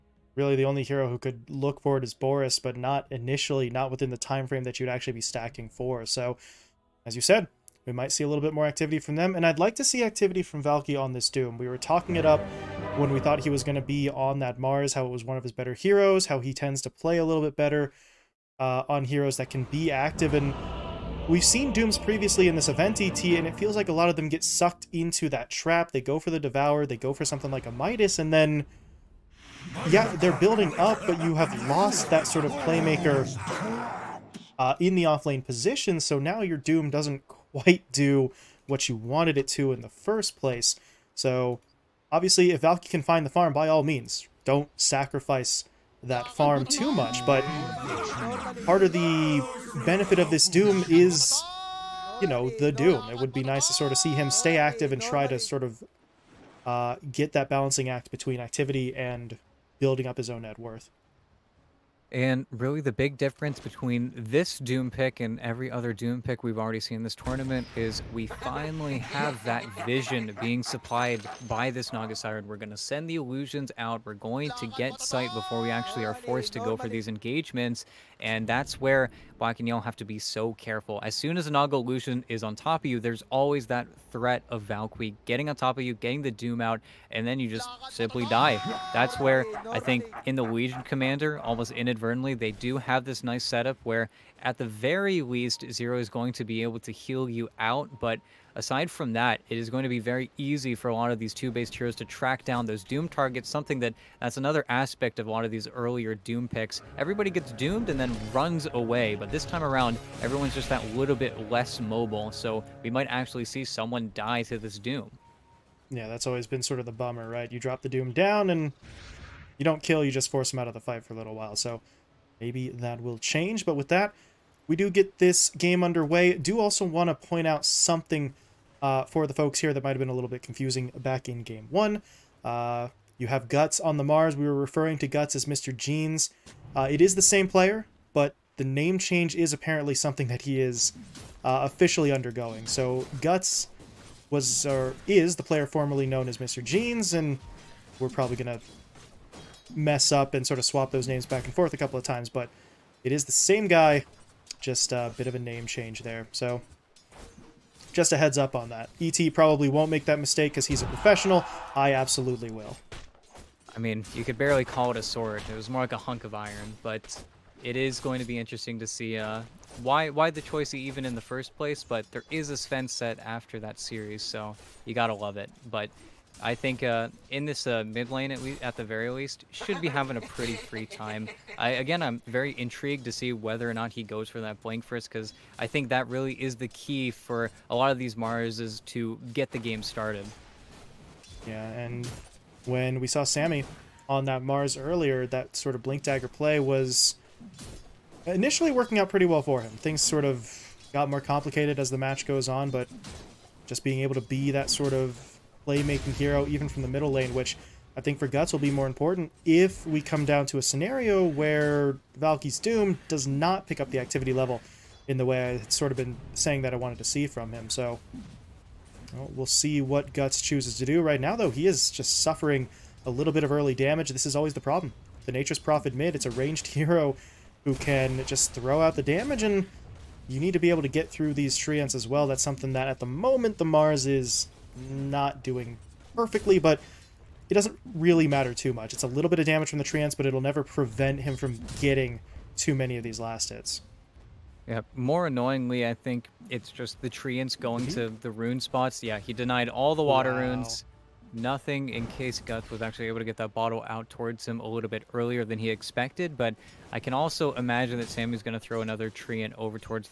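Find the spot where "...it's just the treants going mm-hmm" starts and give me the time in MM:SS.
04:06.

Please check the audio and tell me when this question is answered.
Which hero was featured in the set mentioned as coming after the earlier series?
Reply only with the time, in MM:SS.
02:52.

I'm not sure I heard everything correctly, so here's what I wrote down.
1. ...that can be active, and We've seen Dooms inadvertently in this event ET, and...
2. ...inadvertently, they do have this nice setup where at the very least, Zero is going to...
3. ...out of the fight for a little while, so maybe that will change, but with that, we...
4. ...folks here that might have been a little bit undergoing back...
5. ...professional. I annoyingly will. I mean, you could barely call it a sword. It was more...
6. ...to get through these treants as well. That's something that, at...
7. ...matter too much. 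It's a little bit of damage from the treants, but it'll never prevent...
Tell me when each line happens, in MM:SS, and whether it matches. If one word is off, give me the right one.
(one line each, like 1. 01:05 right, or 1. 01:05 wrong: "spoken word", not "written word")
1. 00:19 wrong: "previously", not "inadvertently"
2. 01:31 right
3. 02:00 right
4. 02:09 wrong: "confusing", not "undergoing"
5. 02:40 wrong: "absolutely", not "annoyingly"
6. 03:50 right
7. 03:58 right.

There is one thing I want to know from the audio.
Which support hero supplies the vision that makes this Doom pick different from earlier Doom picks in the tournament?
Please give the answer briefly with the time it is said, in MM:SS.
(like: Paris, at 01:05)
Naga Siren, at 01:11.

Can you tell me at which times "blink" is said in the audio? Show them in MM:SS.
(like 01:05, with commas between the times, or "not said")
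03:04, 03:15.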